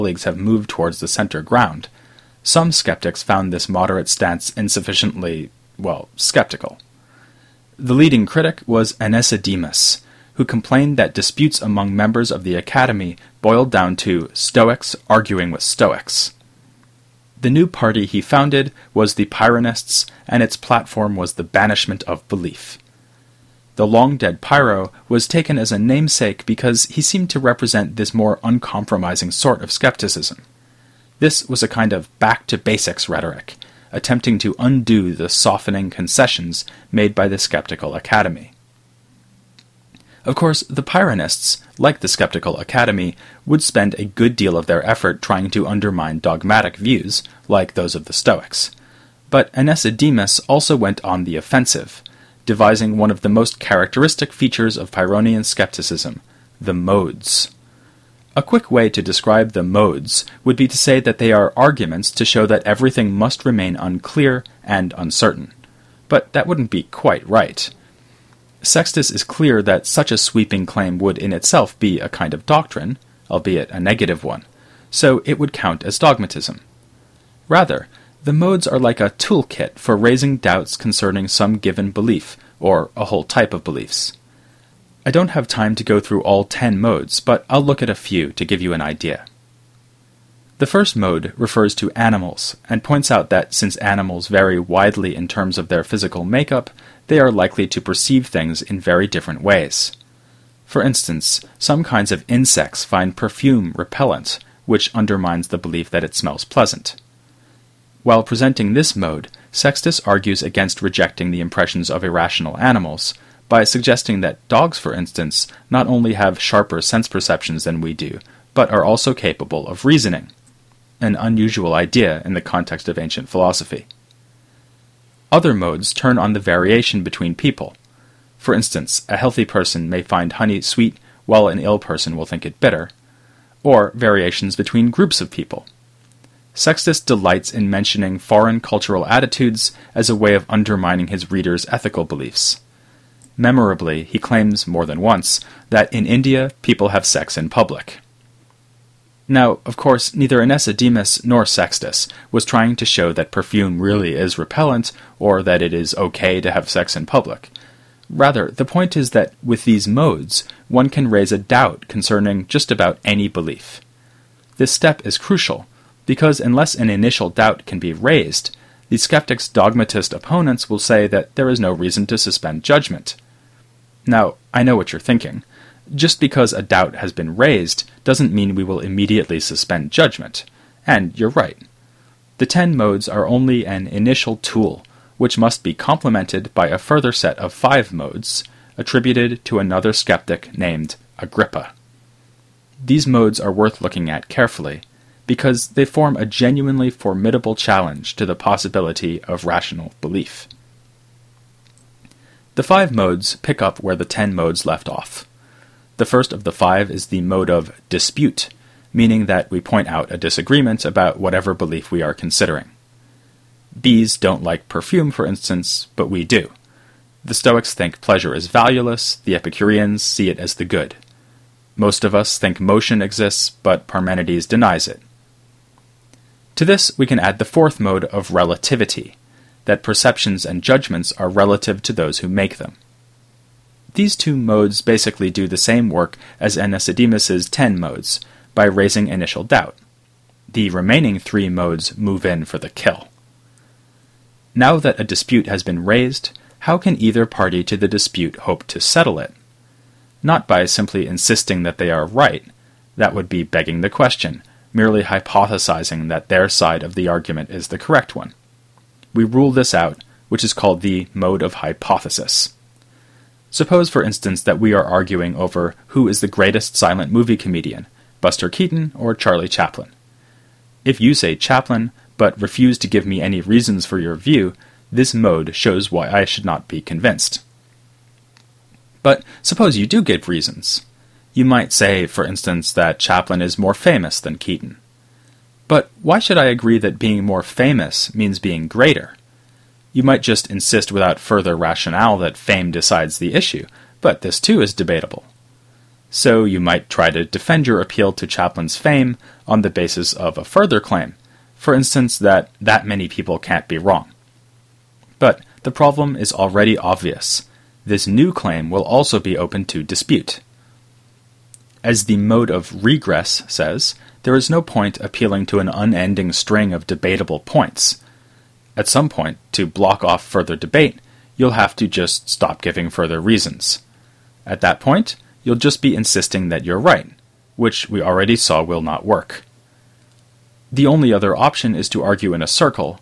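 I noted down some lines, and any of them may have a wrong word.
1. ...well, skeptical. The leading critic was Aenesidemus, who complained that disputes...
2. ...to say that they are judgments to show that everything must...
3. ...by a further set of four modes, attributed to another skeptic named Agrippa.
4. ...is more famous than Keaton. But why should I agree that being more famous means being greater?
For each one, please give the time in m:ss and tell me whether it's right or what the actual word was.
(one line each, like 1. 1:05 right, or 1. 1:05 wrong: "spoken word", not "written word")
1. 0:05 right
2. 1:00 wrong: "arguments", not "judgments"
3. 3:06 wrong: "five", not "four"
4. 4:43 right.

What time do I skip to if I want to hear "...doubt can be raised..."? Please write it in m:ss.
2:47.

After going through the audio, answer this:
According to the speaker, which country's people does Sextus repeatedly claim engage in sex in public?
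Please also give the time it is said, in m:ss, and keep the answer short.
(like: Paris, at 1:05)
India, at 2:26.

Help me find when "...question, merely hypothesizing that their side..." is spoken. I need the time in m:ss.
4:13.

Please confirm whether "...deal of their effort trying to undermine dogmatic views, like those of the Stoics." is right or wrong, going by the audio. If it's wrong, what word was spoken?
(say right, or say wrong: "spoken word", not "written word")
right.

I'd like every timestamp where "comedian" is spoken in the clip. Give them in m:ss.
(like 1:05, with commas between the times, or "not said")
4:27.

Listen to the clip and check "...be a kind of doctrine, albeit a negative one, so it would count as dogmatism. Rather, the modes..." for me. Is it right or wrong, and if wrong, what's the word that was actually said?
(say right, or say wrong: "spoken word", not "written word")
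right.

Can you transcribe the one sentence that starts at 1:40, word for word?
For instance, some kinds of insects find perfume repellent, which undermines the belief that it smells pleasant.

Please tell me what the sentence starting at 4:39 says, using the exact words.
But suppose you do give reasons.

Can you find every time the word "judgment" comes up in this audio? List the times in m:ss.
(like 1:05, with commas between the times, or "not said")
2:52, 2:59, 3:50.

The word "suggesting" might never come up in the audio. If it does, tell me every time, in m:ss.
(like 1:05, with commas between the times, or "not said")
1:53.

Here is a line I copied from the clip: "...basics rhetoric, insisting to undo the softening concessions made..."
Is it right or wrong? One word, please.
wrong.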